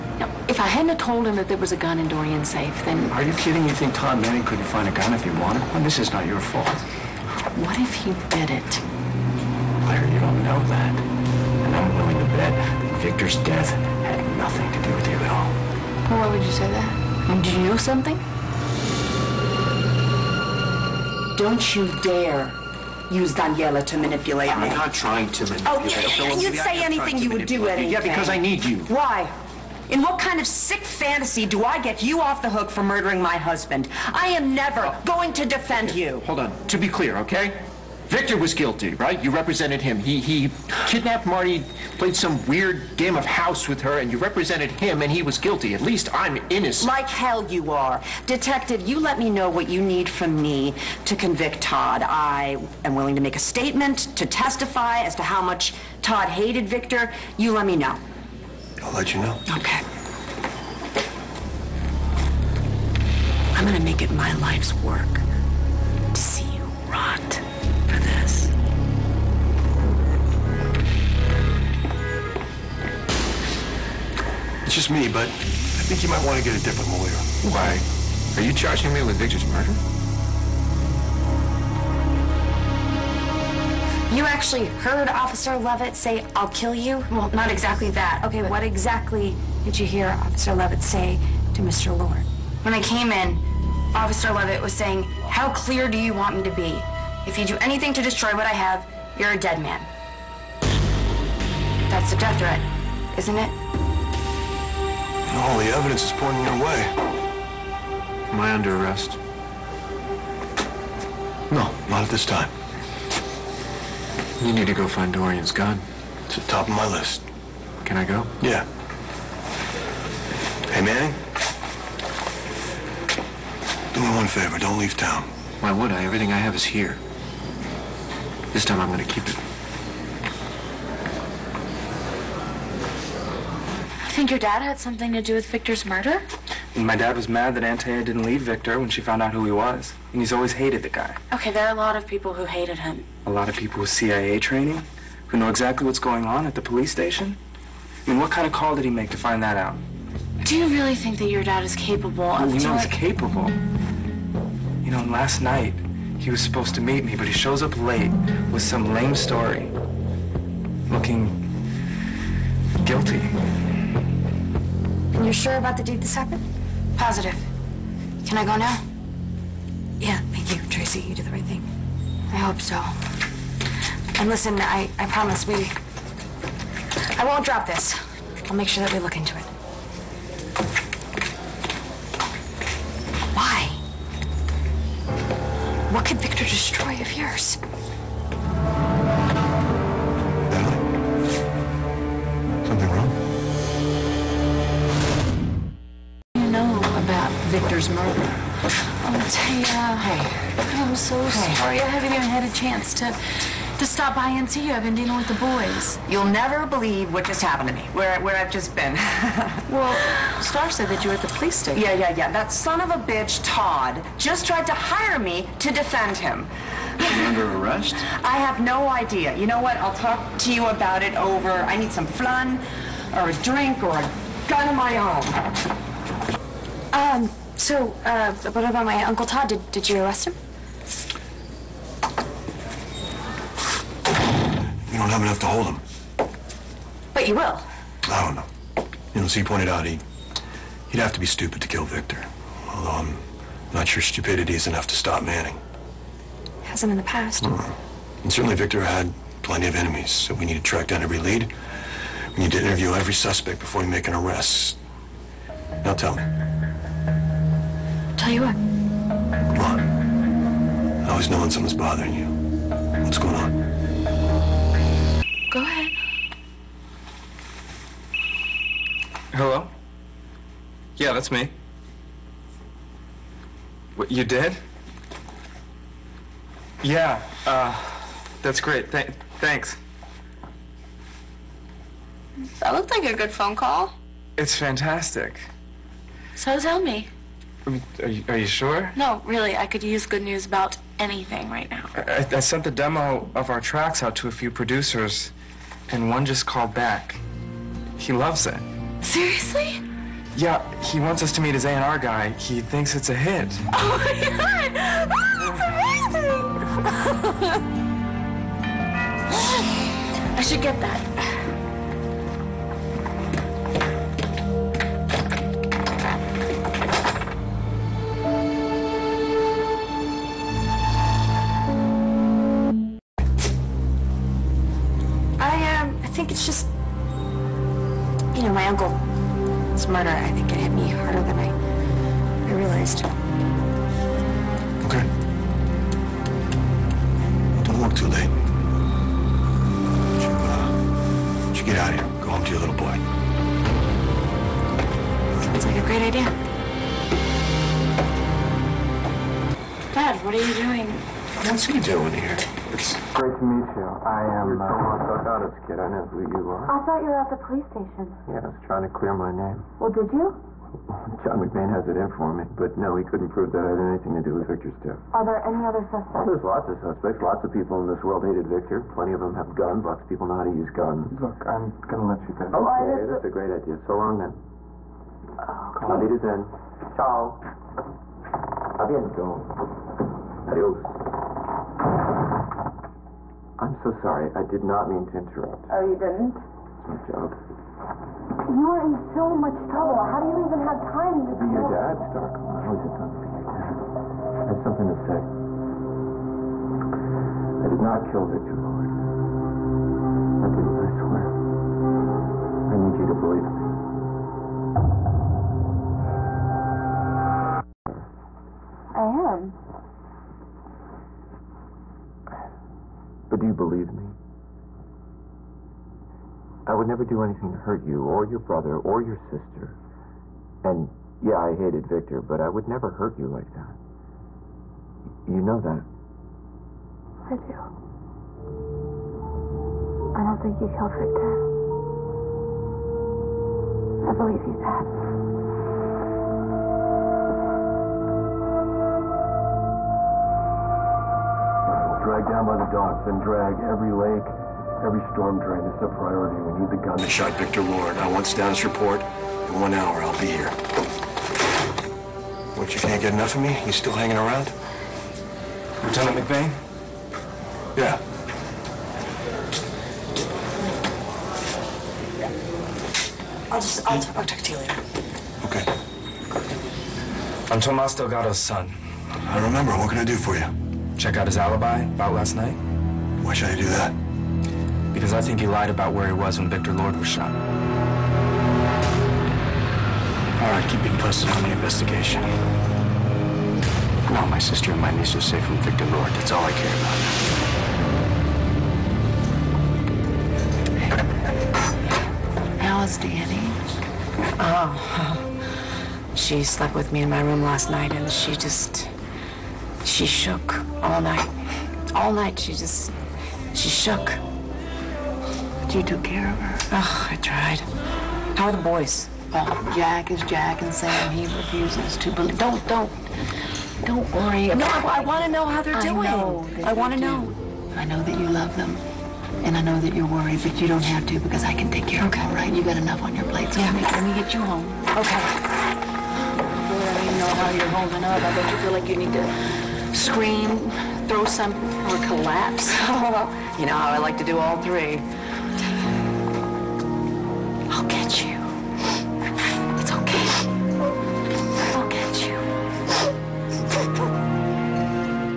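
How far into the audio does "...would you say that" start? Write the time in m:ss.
0:16.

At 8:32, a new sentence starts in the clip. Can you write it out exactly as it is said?
Don't, don't, don't worry No, I, I want to know how they're doing.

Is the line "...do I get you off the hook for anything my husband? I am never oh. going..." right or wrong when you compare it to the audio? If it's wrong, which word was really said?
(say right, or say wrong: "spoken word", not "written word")
wrong: "murdering", not "anything".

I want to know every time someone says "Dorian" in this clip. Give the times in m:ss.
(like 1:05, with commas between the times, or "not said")
0:02, 1:55.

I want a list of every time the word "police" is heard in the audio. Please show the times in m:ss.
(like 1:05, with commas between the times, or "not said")
2:26, 3:31, 5:57.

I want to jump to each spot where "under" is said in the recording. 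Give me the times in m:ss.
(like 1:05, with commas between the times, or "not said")
1:48, 3:37.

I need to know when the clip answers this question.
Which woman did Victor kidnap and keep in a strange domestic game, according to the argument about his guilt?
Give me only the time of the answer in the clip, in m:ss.
0:41.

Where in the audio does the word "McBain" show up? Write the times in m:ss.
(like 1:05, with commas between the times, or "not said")
6:01, 7:36.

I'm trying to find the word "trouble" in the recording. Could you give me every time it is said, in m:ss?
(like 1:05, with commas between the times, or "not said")
6:29.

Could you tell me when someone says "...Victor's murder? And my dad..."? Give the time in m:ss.
2:15.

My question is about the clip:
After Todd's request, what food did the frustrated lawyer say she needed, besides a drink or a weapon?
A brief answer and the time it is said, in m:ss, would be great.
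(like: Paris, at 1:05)
Flan, at 3:42.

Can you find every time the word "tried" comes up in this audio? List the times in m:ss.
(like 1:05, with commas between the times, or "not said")
3:34, 8:27.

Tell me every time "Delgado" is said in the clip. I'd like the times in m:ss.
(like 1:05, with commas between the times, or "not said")
5:55, 7:47.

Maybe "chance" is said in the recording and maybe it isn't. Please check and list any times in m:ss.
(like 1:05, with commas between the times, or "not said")
3:22.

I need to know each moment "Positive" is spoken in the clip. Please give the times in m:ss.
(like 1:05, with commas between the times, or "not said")
2:47.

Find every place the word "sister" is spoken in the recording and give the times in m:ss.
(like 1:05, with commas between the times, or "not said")
6:59, 8:04.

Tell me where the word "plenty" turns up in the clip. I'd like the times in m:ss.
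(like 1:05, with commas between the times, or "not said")
4:09, 6:08.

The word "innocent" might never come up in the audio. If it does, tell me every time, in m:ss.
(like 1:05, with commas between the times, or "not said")
0:46.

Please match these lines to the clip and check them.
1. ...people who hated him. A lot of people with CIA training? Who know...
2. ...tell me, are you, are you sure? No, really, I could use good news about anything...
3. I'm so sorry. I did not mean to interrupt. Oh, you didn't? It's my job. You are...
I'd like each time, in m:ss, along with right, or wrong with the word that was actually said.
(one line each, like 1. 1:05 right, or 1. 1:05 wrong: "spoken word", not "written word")
1. 2:22 right
2. 4:46 right
3. 6:23 right.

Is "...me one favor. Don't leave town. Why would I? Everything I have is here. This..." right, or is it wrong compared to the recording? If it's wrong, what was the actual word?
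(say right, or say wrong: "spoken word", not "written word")
right.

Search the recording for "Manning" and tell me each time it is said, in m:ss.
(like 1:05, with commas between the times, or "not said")
0:04, 2:00, 4:05.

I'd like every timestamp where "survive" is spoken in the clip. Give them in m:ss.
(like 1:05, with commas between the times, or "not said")
not said.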